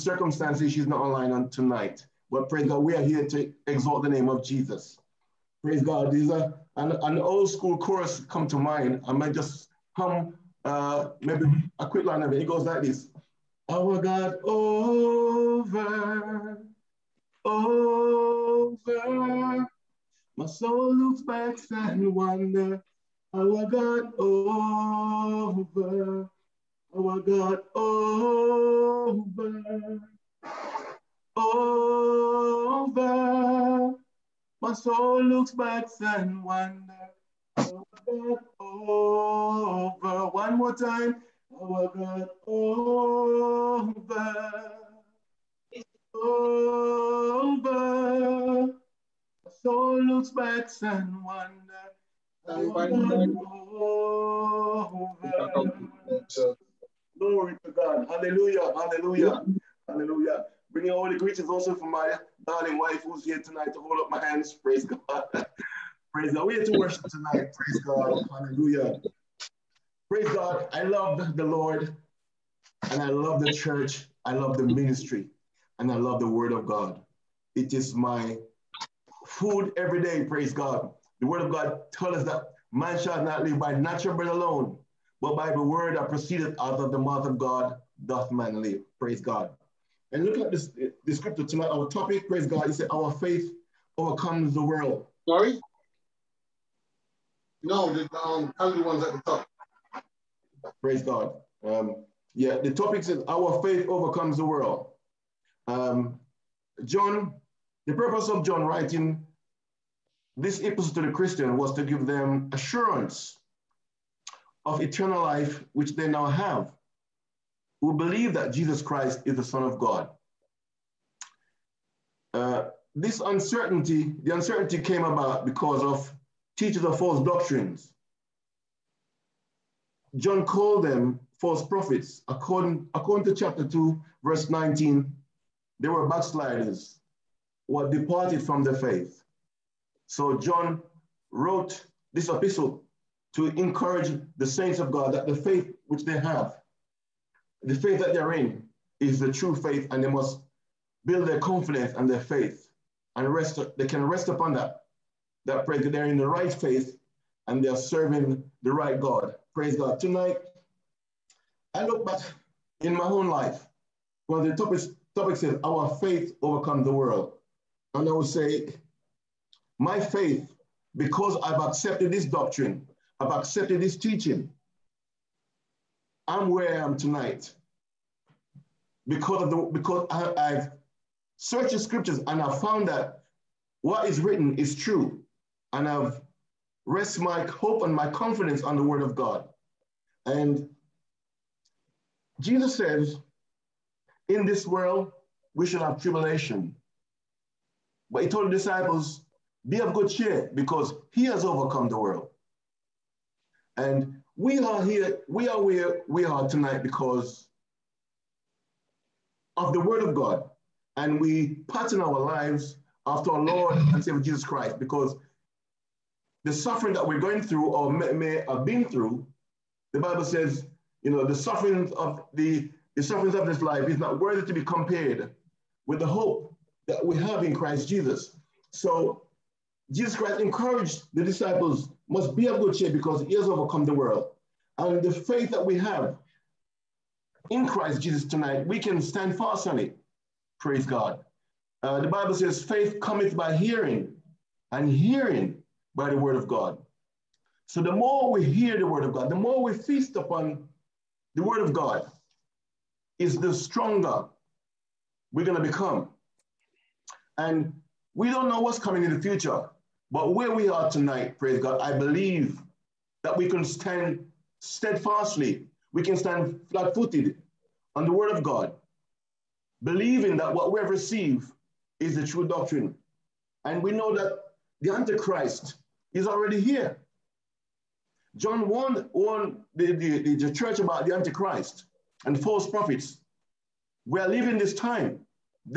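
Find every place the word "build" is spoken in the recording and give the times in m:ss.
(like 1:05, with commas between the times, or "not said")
2:31.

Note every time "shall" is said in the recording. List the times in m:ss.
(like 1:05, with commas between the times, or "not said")
1:22, 3:15.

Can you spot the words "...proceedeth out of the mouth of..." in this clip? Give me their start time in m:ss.
1:26.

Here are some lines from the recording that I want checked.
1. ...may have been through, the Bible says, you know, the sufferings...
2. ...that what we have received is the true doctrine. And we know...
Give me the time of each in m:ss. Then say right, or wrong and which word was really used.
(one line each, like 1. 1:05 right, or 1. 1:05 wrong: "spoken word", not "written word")
1. 3:38 right
2. 4:30 right.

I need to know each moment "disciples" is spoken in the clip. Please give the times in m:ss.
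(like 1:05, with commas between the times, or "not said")
3:18, 3:51.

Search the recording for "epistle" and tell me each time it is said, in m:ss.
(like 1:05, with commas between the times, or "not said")
1:50, 2:22.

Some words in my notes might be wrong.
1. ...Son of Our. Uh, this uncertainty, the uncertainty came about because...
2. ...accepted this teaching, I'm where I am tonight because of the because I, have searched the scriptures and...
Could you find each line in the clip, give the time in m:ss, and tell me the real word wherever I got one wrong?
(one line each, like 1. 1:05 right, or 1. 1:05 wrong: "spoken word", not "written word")
1. 1:59 wrong: "God", not "Our"
2. 2:53 right.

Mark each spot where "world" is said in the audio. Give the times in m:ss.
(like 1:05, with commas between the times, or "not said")
1:34, 1:44, 2:46, 3:14, 3:21, 3:53.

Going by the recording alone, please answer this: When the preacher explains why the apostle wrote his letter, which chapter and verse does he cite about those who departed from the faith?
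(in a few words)
Chapter 2, verse 19.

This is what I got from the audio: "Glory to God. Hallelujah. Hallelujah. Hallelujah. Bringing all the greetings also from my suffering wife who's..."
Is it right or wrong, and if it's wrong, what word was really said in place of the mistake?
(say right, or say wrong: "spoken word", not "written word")
wrong: "darling", not "suffering".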